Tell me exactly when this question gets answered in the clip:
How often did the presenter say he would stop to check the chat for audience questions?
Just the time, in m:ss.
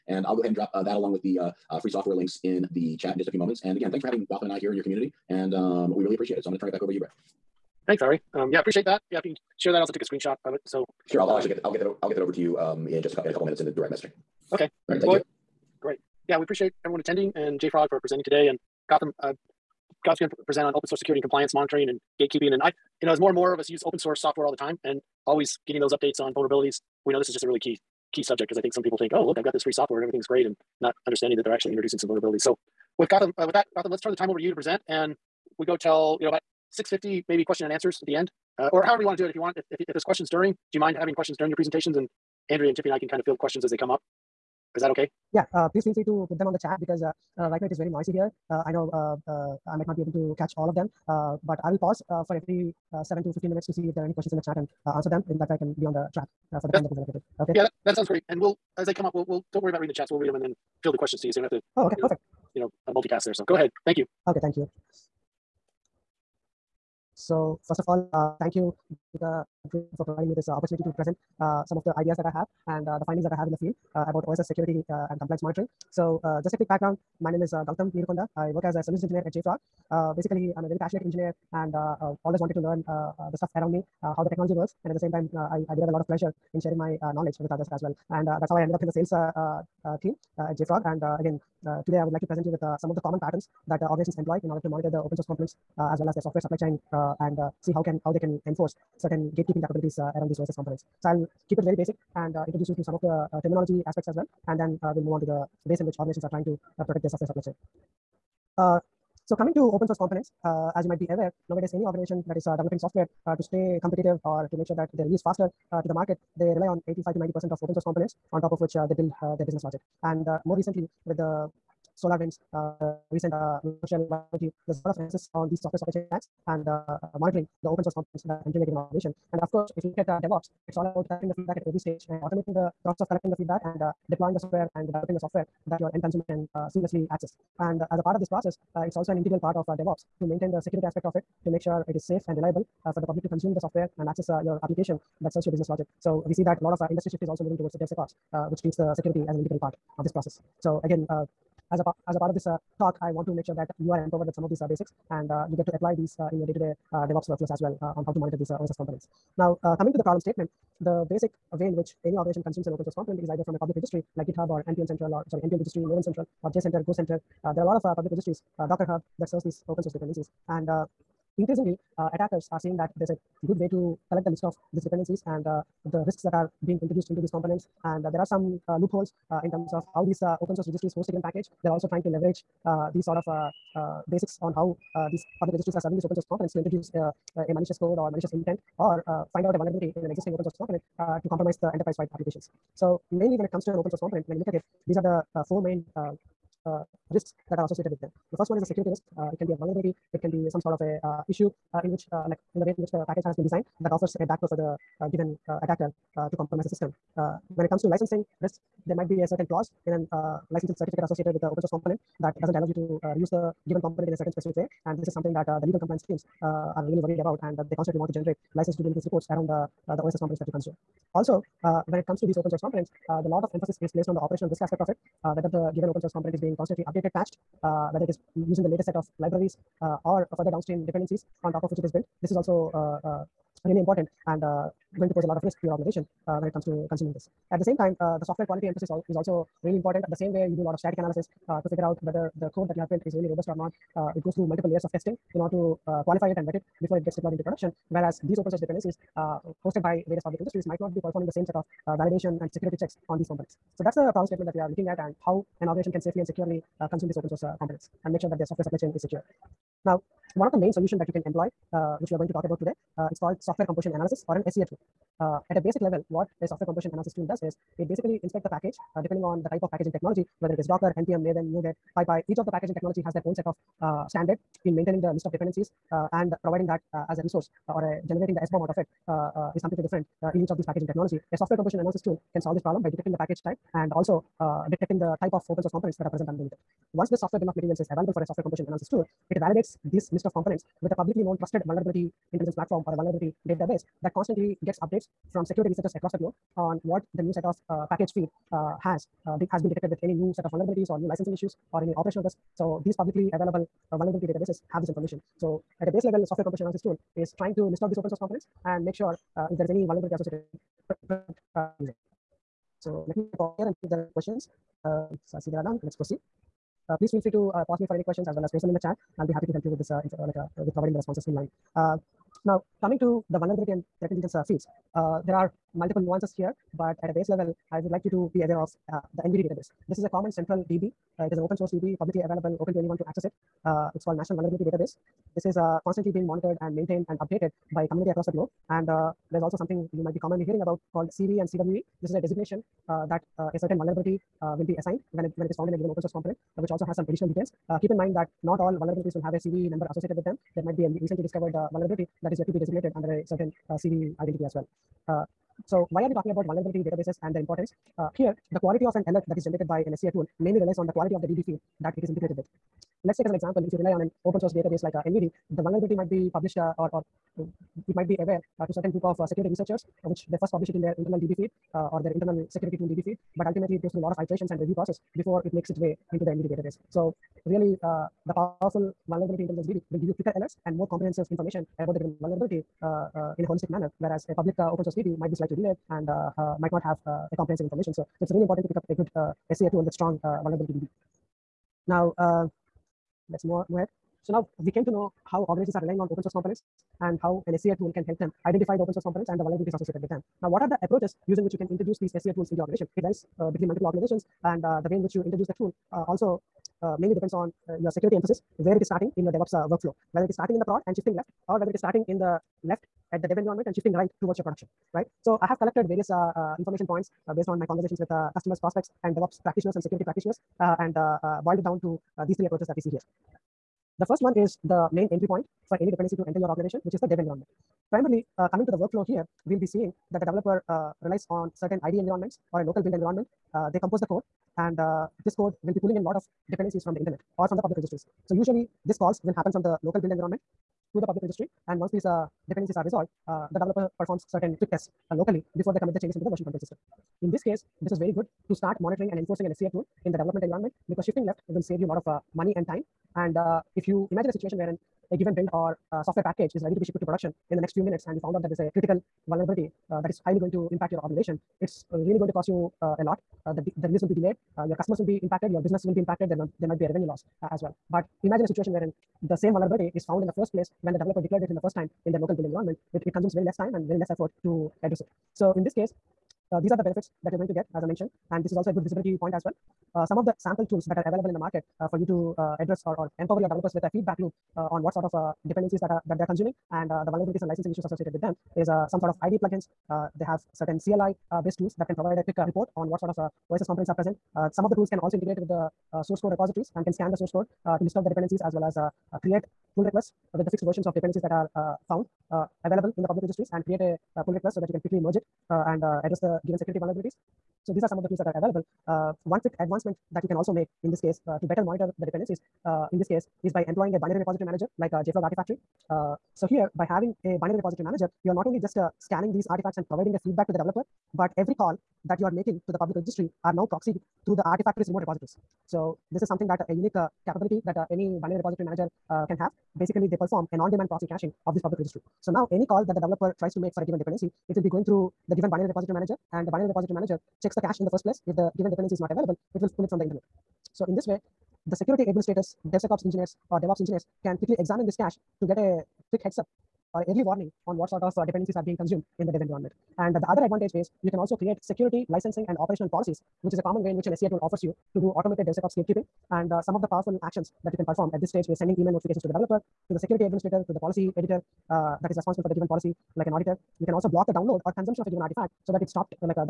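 0:52.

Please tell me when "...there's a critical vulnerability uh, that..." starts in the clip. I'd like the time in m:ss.
7:38.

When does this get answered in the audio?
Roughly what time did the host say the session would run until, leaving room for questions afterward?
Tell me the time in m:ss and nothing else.
0:36.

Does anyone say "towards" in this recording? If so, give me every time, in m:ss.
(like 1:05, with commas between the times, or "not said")
2:27, 6:54.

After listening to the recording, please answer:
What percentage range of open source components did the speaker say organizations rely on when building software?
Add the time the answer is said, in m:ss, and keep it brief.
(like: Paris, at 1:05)
85 to 90%, at 1:56.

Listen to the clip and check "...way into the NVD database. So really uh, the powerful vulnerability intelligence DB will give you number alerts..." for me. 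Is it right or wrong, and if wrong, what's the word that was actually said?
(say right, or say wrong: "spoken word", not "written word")
wrong: "quicker", not "number".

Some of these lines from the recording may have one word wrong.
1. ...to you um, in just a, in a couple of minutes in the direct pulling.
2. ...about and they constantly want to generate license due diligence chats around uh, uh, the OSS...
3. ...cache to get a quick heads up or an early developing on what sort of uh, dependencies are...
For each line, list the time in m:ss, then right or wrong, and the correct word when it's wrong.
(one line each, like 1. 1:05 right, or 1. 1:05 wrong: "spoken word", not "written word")
1. 0:12 wrong: "messaging", not "pulling"
2. 3:37 wrong: "reports", not "chats"
3. 9:04 wrong: "warning", not "developing".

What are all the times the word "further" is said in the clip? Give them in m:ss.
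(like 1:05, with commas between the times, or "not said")
3:50.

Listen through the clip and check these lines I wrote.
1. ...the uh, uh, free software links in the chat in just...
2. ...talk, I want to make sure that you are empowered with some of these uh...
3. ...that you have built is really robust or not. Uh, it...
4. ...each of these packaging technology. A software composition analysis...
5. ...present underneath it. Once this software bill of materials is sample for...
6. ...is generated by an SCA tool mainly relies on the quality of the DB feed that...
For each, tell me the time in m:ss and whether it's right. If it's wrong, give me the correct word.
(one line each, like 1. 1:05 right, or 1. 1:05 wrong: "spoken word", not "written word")
1. 0:01 right
2. 2:32 right
3. 4:02 right
4. 4:40 right
5. 4:46 wrong: "available", not "sample"
6. 5:59 right.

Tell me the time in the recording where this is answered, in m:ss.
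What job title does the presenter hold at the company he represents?
1:18.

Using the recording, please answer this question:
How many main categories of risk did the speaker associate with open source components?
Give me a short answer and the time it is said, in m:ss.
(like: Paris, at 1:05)
4, at 3:15.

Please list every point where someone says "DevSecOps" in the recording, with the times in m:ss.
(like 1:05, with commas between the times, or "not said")
2:27, 9:02, 9:15.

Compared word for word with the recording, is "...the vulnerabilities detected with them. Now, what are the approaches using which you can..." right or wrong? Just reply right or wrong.
wrong.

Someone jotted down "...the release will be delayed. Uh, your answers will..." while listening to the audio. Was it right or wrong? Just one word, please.
wrong.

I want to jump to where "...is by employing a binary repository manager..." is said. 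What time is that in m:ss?
8:33.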